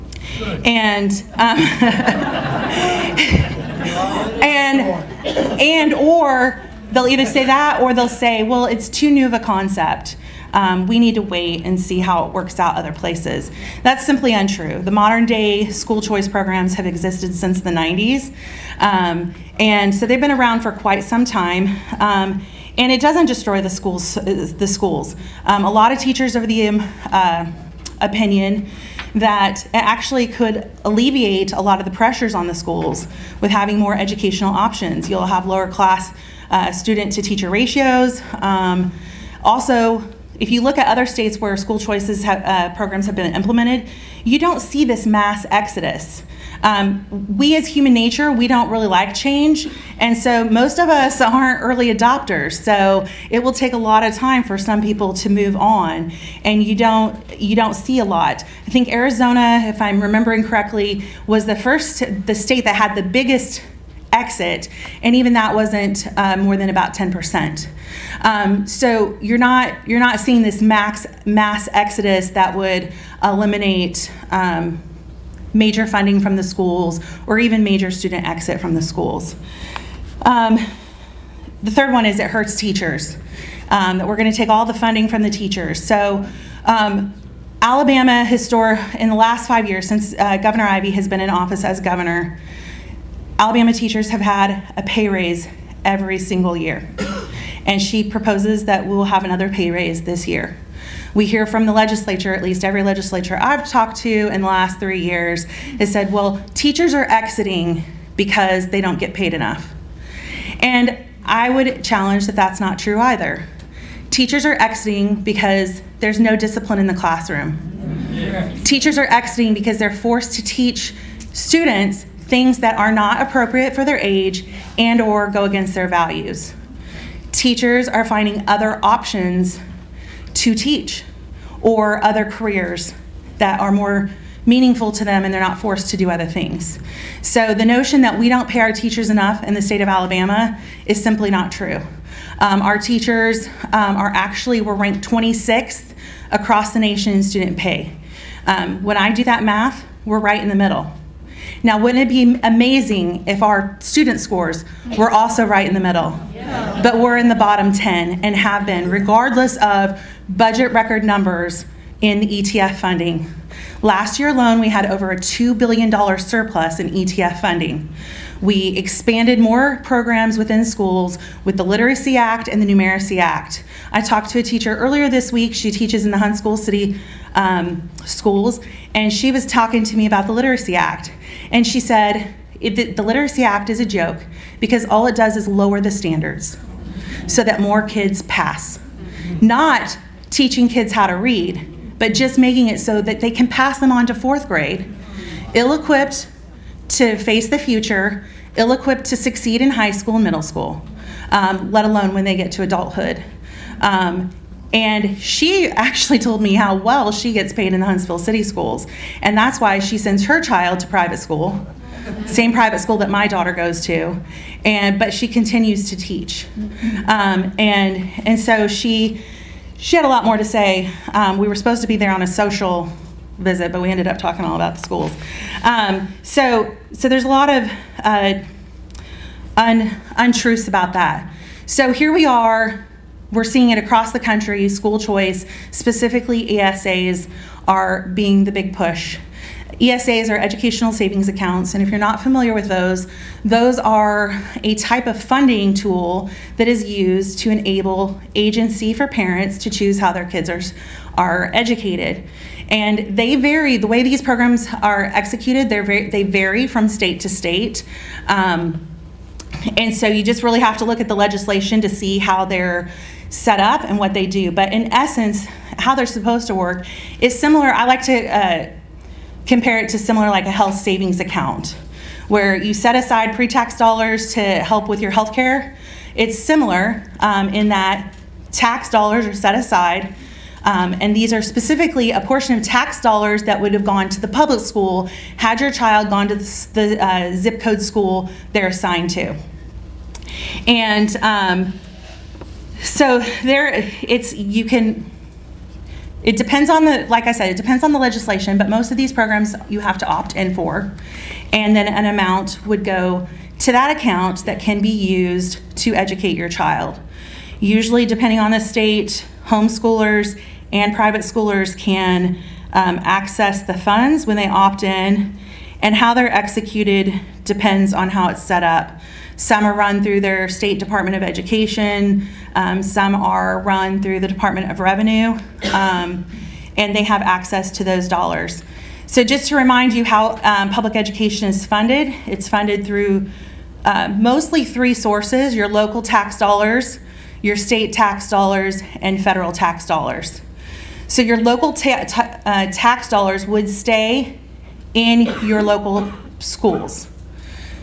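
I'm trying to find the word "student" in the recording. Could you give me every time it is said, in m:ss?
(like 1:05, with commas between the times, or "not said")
0:36, 1:17, 2:01, 2:27, 2:33.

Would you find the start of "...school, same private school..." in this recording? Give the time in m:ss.
3:31.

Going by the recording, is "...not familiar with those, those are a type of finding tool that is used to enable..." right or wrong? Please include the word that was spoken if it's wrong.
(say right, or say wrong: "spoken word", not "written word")
wrong: "funding", not "finding".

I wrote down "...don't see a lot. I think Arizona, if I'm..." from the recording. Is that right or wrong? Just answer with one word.
right.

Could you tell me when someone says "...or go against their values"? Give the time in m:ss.
2:04.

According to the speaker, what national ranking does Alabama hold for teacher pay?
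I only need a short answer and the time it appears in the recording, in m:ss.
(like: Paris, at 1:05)
26th, at 2:25.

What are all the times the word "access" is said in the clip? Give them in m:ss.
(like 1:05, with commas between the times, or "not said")
5:13, 5:27.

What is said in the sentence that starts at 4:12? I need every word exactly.
And they vary, the way these programs are executed, very, they vary from state to state.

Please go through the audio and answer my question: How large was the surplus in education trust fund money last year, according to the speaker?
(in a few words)
Over $2 billion.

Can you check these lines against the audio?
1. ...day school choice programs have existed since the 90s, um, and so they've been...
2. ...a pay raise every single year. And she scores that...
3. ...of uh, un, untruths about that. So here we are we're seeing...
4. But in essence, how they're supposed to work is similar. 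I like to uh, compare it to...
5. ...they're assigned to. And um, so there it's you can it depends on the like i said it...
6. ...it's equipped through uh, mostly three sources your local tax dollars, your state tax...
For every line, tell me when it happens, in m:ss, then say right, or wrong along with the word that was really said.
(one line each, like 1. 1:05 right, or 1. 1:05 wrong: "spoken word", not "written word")
1. 0:15 right
2. 1:34 wrong: "proposes", not "scores"
3. 3:47 right
4. 4:24 right
5. 4:48 right
6. 5:32 wrong: "funded", not "equipped".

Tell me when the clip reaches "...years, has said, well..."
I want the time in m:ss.
1:44.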